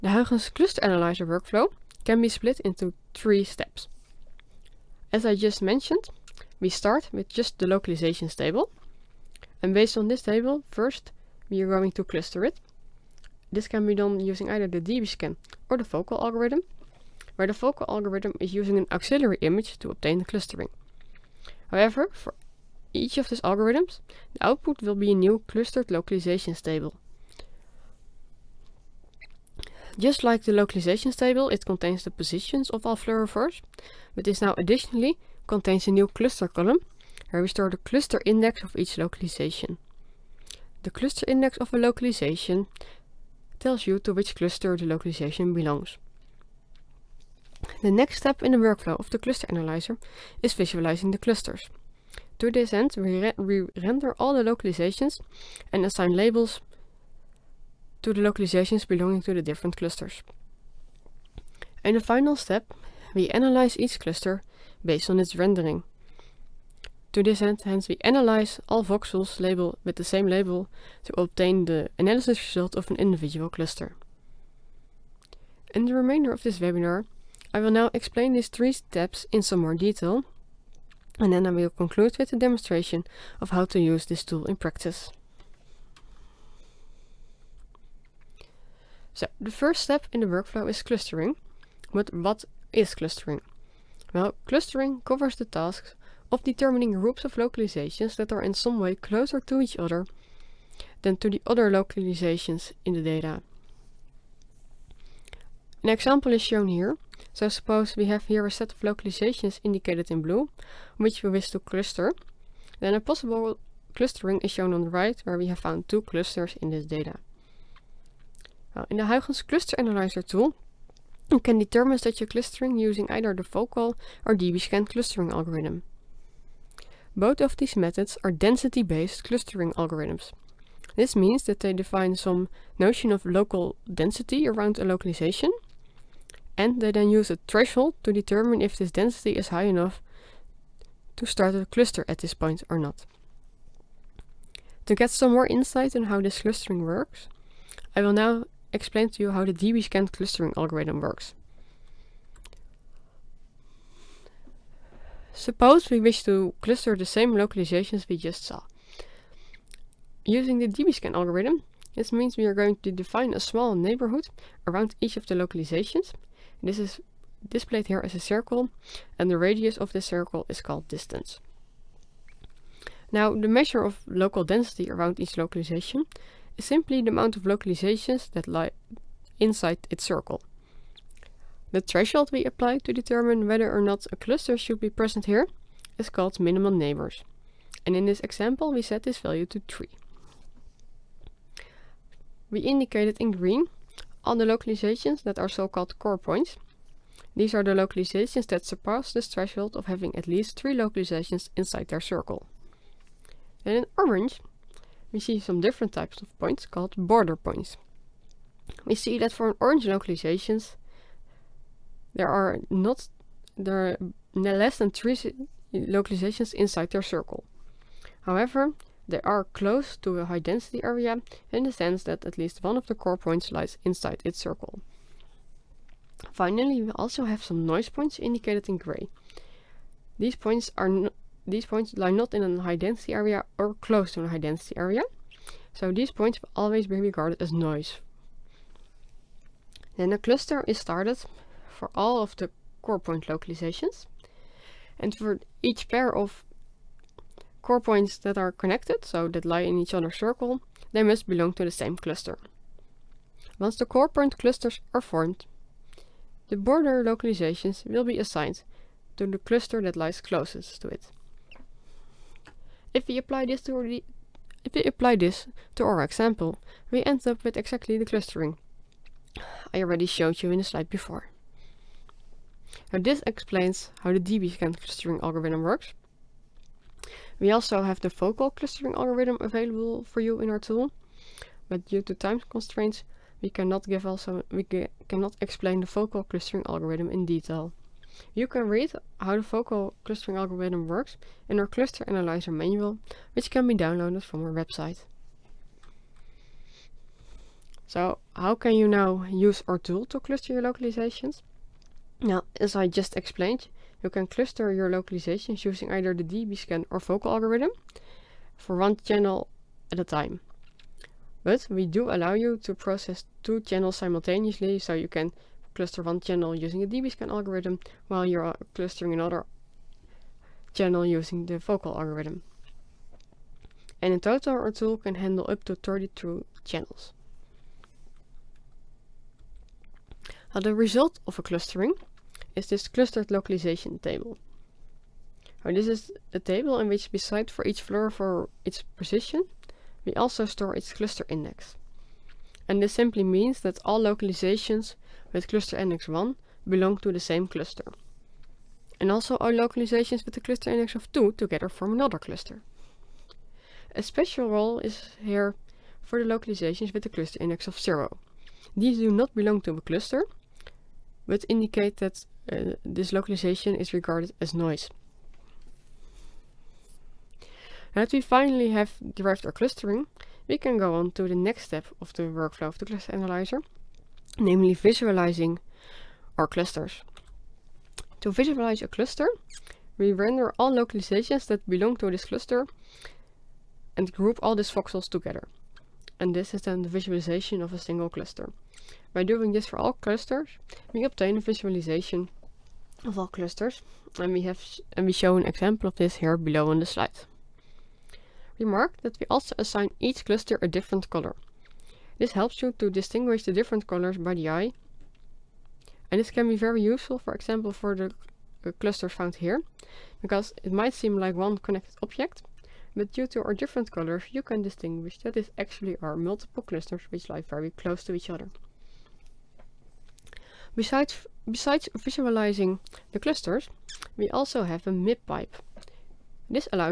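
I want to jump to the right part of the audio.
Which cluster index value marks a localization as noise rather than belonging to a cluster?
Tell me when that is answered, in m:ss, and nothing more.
5:57.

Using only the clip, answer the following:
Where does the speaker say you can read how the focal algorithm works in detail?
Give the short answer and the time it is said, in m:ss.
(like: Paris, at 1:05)
cluster analyzer manual, at 4:51.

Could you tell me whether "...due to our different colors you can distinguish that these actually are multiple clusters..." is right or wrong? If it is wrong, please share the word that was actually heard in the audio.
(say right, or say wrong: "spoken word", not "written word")
right.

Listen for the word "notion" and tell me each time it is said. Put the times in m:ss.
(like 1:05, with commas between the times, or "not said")
2:12.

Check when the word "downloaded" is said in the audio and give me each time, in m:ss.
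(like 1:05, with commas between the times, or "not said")
4:53.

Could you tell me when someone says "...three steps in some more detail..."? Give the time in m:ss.
1:18.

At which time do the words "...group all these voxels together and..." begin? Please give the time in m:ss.
6:24.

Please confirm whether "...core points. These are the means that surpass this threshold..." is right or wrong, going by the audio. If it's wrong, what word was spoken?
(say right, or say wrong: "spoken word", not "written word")
wrong: "localizations", not "means".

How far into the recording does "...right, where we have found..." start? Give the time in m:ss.
1:54.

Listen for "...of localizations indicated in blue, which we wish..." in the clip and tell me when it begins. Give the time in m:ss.
1:48.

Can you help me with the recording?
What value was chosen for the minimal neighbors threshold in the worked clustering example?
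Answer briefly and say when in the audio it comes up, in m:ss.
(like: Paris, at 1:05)
3, at 3:08.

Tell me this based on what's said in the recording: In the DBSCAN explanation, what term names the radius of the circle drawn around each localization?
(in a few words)
distance.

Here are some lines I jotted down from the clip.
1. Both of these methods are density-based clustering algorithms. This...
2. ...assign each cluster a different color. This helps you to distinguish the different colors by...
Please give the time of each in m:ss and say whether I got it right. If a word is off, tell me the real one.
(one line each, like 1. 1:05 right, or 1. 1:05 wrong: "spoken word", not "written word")
1. 2:07 right
2. 6:39 right.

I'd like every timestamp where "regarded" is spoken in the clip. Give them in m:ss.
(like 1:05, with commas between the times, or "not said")
3:57, 6:03.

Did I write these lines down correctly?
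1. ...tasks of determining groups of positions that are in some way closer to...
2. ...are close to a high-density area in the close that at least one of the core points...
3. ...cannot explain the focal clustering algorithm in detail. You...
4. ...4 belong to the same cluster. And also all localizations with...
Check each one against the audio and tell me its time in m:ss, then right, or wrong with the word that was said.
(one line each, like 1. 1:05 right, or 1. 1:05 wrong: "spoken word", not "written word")
1. 1:35 wrong: "localizations", not "positions"
2. 3:39 wrong: "sense", not "close"
3. 4:45 right
4. 5:46 wrong: "1", not "4".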